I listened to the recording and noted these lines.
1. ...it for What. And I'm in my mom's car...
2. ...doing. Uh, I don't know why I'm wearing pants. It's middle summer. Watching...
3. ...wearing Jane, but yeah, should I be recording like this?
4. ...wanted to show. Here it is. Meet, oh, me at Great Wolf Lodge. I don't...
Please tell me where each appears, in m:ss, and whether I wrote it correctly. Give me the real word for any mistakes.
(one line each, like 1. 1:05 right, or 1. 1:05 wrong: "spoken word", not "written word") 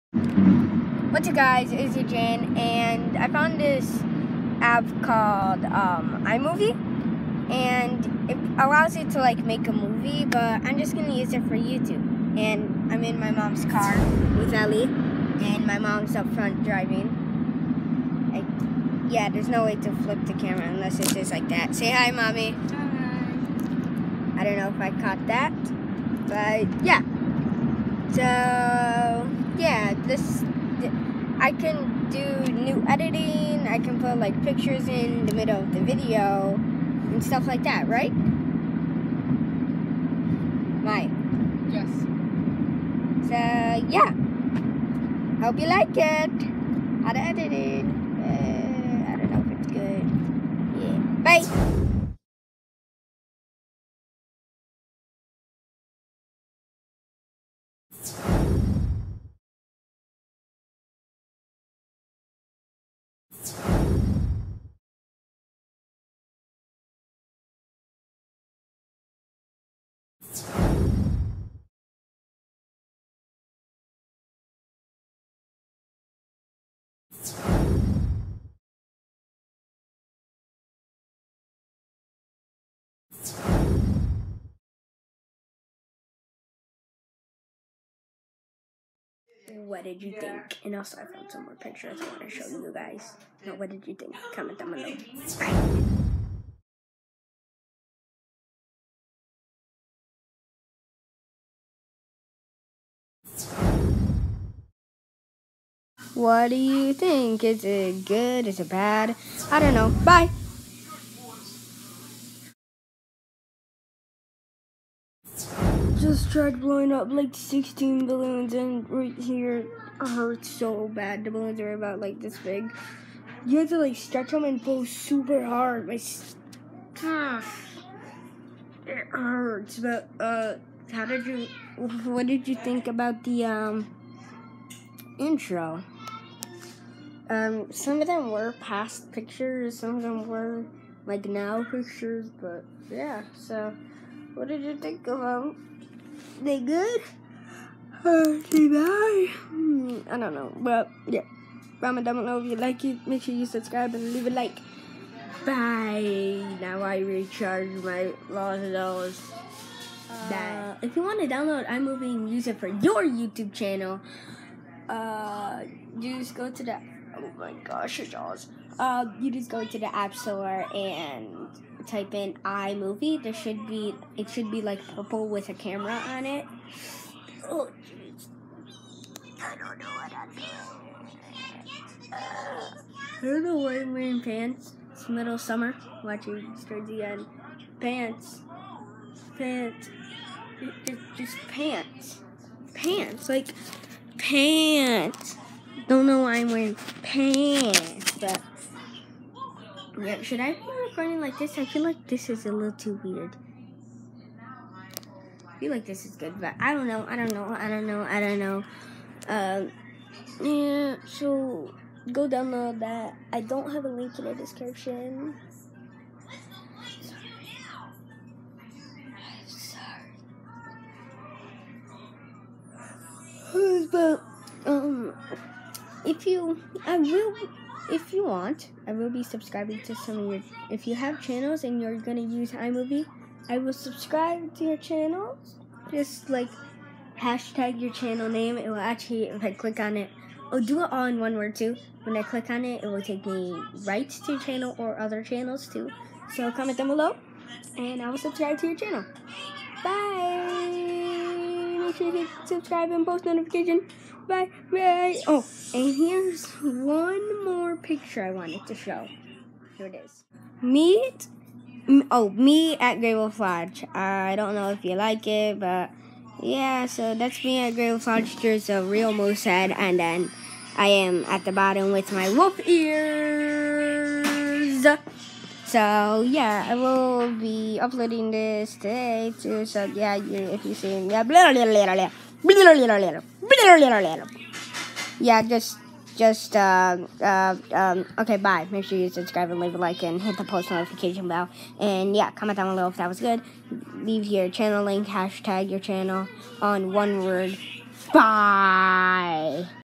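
1. 0:11 wrong: "YouTube", not "What"
2. 3:00 right
3. 3:16 wrong: "Okay", not "Jane"
4. 4:18 right.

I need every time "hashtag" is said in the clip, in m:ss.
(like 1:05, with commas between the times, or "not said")
3:57, 4:55.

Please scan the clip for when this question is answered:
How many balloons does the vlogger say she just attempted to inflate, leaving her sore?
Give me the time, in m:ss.
1:57.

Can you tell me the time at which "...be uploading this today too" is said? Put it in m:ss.
4:37.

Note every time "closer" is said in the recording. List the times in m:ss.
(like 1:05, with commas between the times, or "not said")
not said.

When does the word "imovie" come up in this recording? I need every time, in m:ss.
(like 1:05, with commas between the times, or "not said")
0:06, 2:41, 2:52, 3:52.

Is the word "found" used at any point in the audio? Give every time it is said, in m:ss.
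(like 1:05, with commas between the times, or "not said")
0:03, 1:31.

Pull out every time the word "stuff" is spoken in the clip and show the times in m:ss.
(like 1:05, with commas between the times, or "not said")
0:37.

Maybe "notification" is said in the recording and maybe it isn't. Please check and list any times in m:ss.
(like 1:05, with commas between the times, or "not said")
4:13, 4:50.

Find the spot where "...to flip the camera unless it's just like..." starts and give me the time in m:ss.
0:19.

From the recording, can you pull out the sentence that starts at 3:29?
Um, yeah, so go download that.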